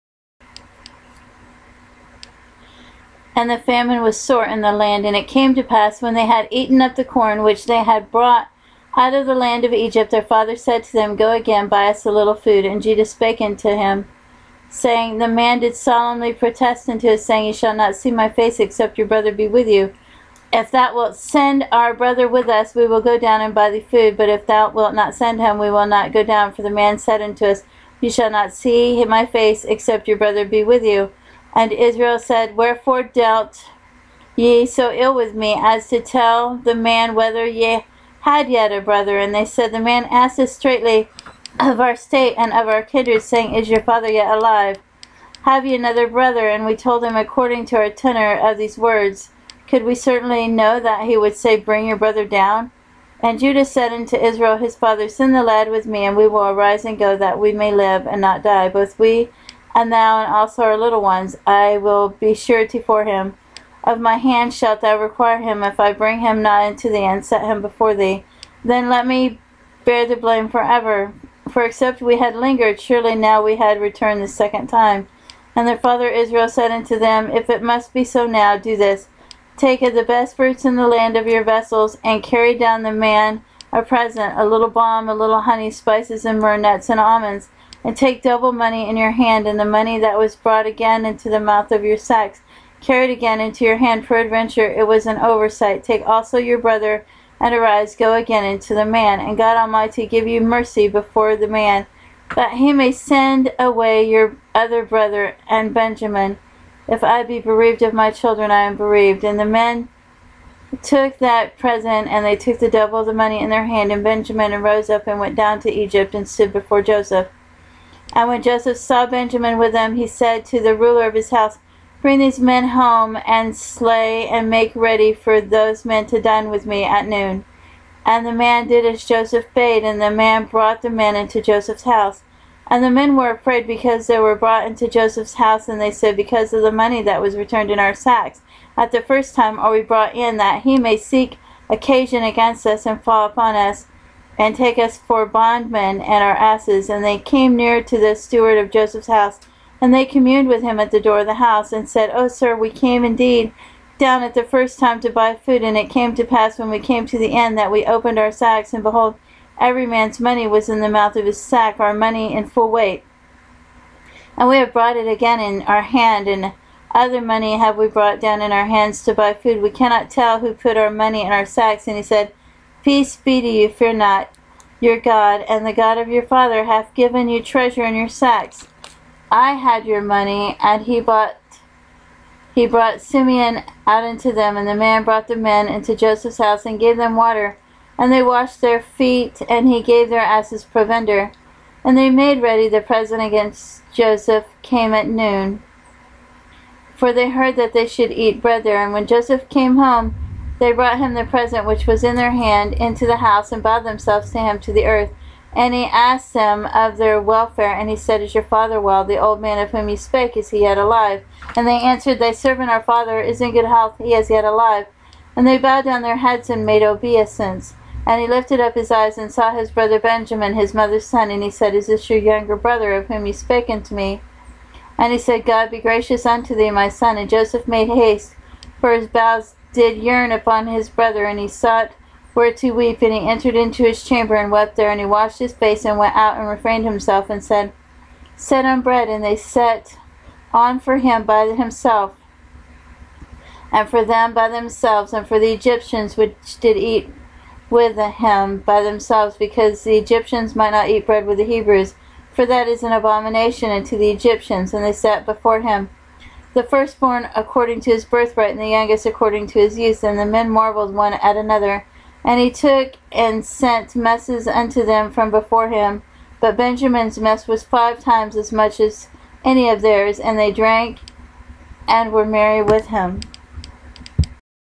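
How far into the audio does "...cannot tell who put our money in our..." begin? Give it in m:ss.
2:49.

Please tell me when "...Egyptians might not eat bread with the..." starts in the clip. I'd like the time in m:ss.
4:09.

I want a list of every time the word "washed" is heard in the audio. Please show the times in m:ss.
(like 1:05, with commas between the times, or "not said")
3:08, 3:55.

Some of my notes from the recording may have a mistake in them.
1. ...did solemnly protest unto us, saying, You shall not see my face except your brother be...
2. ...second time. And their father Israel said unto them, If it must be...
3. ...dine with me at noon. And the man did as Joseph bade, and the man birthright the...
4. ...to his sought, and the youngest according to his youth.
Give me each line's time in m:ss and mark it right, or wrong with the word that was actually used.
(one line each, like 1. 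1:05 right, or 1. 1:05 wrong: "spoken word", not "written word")
1. 0:15 right
2. 1:14 right
3. 2:06 wrong: "brought", not "birthright"
4. 4:17 wrong: "birthright", not "sought".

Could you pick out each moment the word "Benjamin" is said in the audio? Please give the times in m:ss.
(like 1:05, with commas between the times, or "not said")
1:45, 1:54, 1:59, 3:39, 4:26.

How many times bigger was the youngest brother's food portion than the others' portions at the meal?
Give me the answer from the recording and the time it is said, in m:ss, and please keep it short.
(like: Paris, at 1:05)
5, at 4:27.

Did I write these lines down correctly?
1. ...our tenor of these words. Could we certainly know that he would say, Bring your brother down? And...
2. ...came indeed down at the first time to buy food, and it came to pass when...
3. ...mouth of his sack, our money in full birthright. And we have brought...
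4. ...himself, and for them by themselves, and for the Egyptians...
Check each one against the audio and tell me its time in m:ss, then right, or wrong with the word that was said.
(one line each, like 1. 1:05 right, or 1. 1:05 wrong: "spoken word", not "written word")
1. 0:47 right
2. 2:32 right
3. 2:40 wrong: "weight", not "birthright"
4. 4:01 right.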